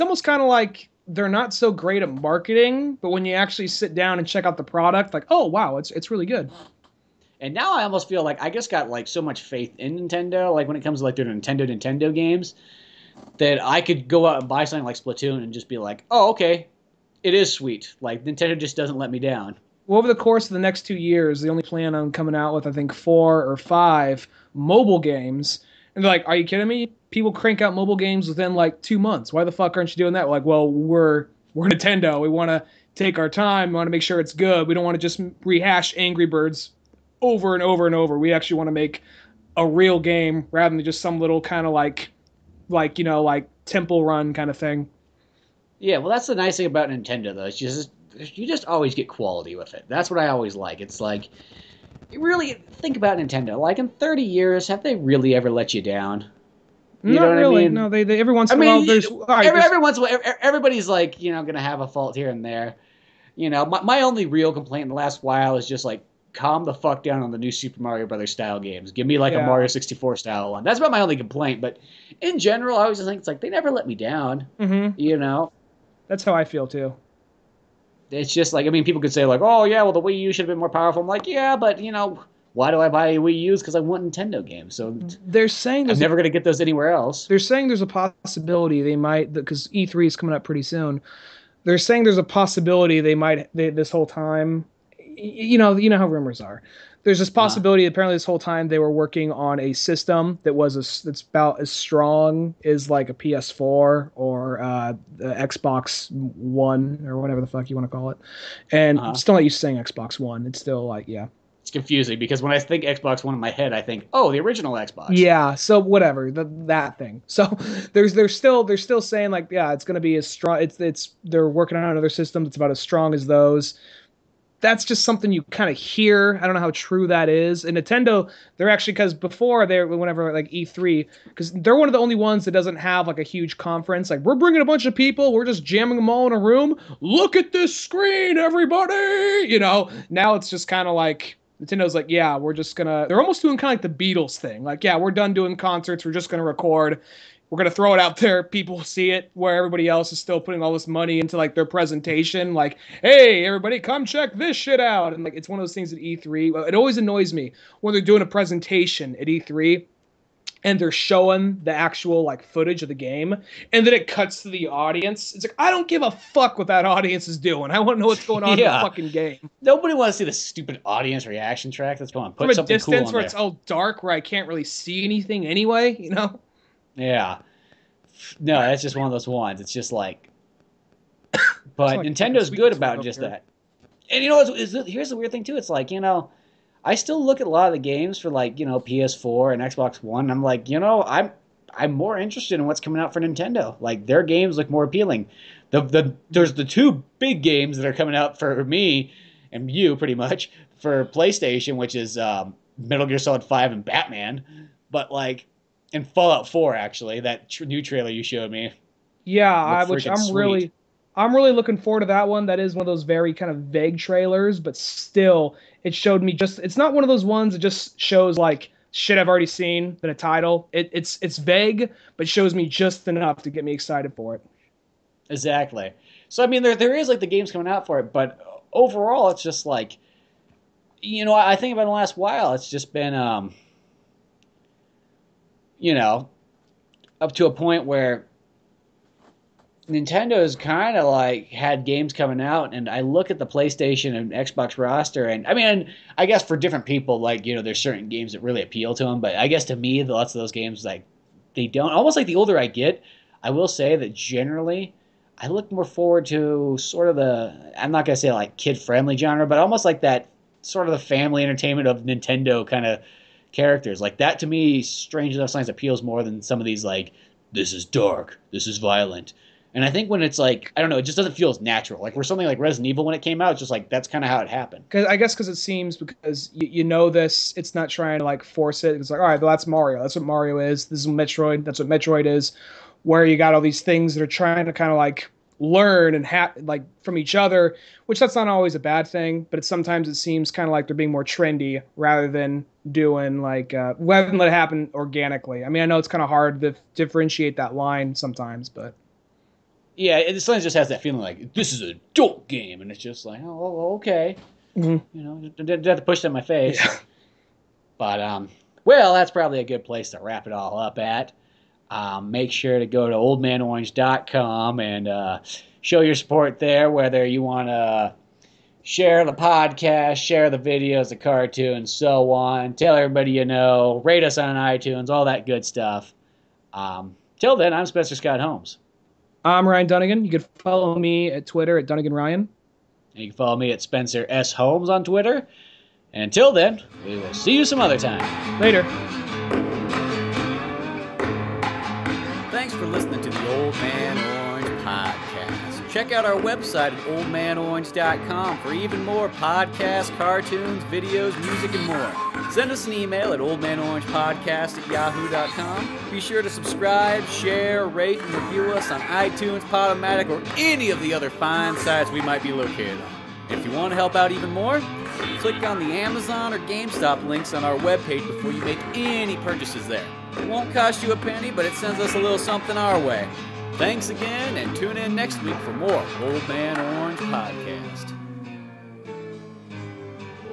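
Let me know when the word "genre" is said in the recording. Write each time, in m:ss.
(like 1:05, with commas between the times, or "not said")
4:19.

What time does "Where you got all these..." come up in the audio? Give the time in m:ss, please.
4:43.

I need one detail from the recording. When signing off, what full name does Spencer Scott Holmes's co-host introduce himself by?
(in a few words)
Ryan Dunigan.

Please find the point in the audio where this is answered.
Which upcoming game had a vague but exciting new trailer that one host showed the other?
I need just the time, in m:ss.
3:26.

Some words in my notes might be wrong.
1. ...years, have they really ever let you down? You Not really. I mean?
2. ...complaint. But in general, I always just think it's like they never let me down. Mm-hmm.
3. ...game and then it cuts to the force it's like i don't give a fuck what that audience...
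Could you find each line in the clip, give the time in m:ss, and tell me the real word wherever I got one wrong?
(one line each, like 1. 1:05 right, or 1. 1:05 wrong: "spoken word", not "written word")
1. 0:54 right
2. 1:11 right
3. 2:42 wrong: "audience", not "force".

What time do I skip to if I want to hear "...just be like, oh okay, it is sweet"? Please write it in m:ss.
0:15.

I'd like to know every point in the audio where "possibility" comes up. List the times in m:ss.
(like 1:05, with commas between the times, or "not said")
1:27, 1:32, 1:37.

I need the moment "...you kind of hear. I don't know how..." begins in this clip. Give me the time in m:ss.
2:05.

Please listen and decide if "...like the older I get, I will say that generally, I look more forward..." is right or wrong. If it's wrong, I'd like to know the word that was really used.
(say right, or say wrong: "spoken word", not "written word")
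right.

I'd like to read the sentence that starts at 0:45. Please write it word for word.
Yeah, well, that's the nice thing about Nintendo though.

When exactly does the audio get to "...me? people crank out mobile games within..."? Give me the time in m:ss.
0:26.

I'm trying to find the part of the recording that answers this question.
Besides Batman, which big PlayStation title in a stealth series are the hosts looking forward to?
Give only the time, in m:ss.
3:22.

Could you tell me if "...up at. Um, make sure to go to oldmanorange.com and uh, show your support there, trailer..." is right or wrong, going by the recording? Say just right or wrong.
wrong.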